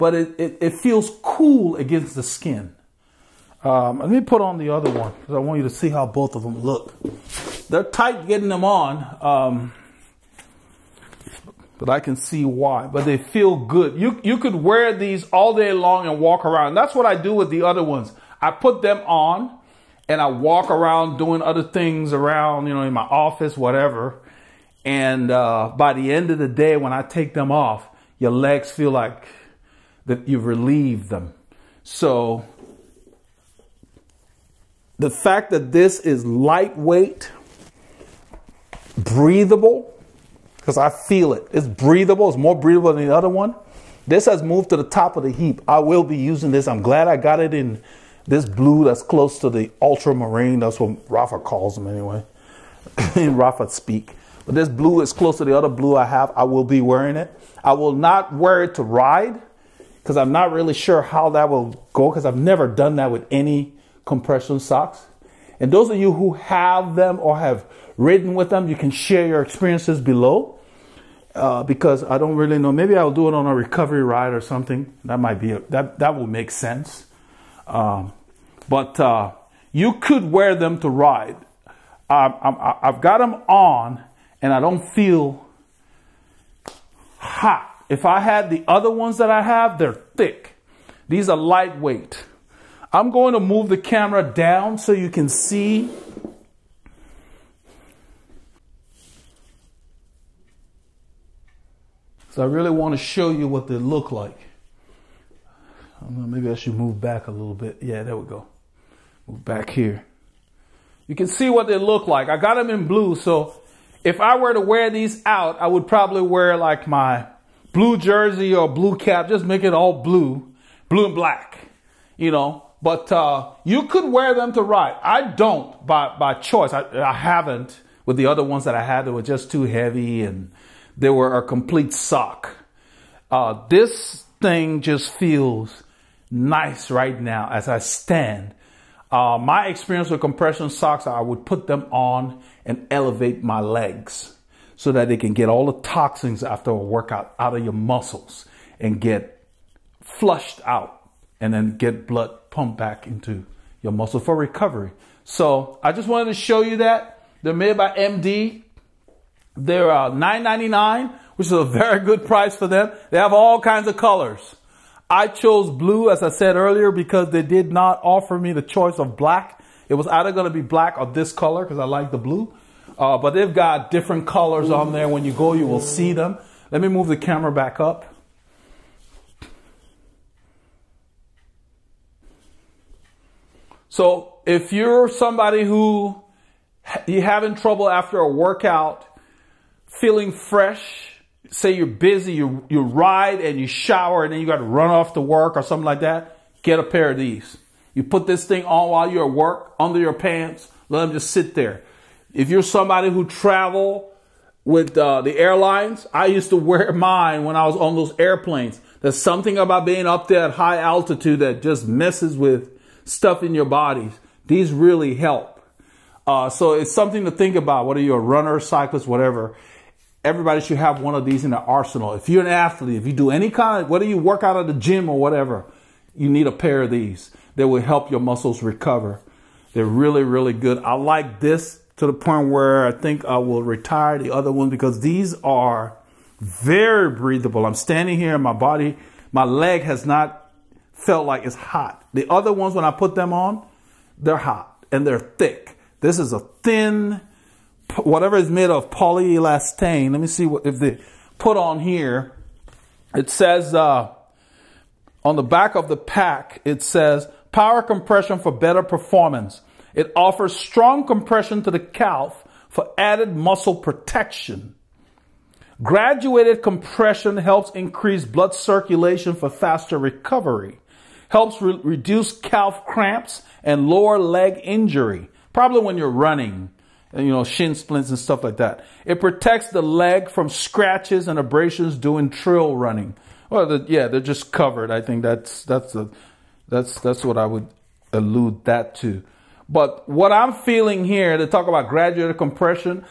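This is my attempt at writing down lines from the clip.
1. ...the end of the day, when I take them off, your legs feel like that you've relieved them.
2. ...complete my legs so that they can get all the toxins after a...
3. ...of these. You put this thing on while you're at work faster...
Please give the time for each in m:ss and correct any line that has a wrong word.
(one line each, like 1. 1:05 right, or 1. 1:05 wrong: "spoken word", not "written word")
1. 0:25 right
2. 2:22 wrong: "elevate", not "complete"
3. 3:17 wrong: "under", not "faster".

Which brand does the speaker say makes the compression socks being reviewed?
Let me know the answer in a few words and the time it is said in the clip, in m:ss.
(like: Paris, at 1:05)
MD, at 2:37.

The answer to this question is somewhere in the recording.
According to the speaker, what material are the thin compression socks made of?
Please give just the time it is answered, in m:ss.
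4:08.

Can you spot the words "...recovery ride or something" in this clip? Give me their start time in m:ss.
1:13.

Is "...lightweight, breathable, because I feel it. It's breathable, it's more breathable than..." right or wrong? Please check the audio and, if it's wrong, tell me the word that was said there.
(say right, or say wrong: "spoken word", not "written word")
right.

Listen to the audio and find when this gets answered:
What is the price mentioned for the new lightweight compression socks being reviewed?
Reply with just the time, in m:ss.
2:40.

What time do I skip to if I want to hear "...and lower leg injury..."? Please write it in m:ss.
4:33.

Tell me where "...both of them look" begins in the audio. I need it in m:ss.
0:06.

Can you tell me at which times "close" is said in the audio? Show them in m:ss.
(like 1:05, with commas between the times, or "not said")
0:49, 0:55.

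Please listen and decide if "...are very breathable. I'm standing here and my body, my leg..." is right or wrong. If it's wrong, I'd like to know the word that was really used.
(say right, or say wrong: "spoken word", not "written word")
right.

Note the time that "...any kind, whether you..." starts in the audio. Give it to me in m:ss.
3:43.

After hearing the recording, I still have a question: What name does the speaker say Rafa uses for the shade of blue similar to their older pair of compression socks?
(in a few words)
ultramarine.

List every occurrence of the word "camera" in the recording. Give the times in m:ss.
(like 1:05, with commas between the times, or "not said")
1:33, 2:57.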